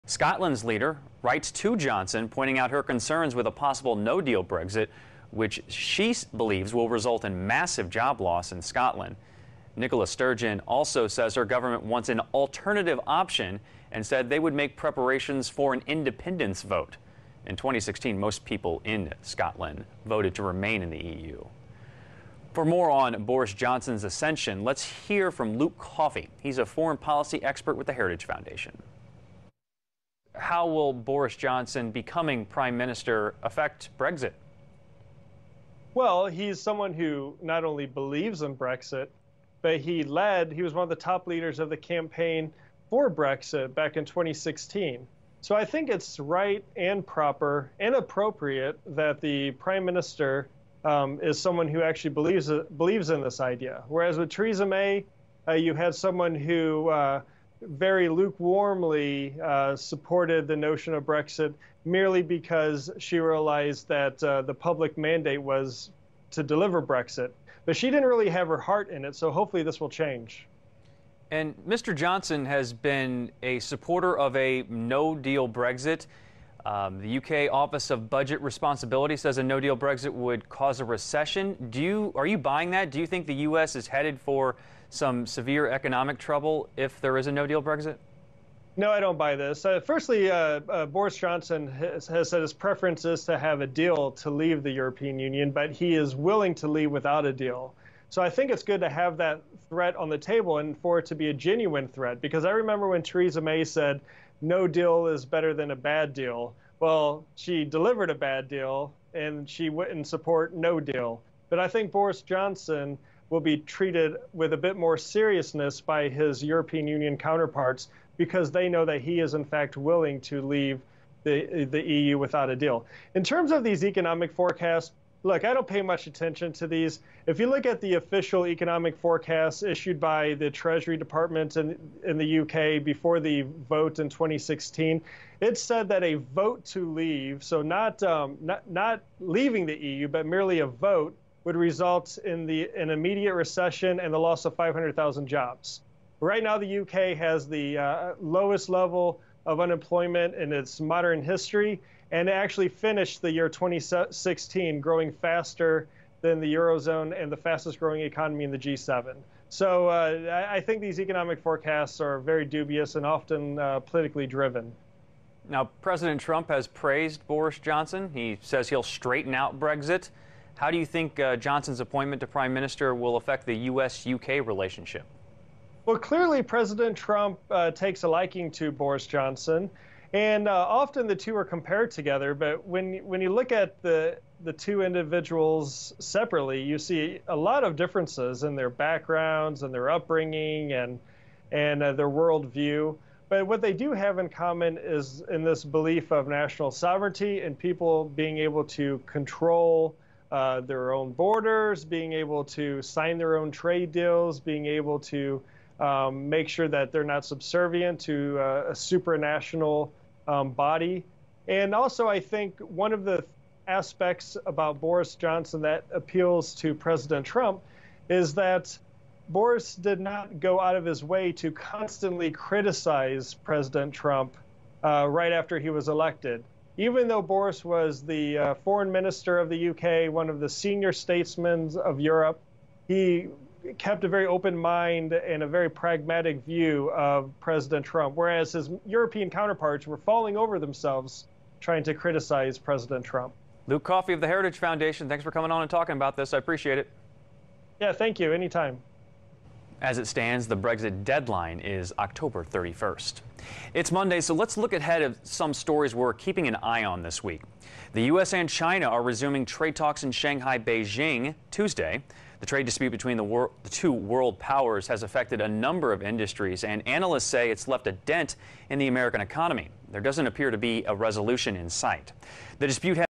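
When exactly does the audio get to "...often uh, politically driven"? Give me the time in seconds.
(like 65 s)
163 s.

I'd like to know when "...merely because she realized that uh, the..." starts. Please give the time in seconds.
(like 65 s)
61 s.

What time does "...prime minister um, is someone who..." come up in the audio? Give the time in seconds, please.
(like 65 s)
49 s.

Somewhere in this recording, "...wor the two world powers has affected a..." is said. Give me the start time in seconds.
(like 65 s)
263 s.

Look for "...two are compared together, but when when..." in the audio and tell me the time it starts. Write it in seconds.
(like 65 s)
181 s.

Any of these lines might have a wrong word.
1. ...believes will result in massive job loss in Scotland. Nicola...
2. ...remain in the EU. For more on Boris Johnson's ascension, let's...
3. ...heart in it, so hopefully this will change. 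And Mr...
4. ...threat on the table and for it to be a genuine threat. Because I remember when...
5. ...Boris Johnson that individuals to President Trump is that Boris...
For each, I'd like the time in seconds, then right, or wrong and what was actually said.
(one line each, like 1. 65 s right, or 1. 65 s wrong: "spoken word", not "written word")
1. 6 s right
2. 20 s right
3. 68 s right
4. 99 s right
5. 214 s wrong: "appeals", not "individuals".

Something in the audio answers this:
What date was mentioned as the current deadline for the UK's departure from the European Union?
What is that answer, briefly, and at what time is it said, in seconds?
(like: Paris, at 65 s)
October 31st, at 251 s.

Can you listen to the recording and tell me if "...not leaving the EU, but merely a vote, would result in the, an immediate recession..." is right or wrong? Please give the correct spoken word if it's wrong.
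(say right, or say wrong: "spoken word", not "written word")
right.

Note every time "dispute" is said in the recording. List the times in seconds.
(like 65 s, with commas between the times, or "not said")
262 s, 272 s.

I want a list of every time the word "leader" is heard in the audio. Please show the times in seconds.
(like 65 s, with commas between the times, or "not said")
0 s, 41 s.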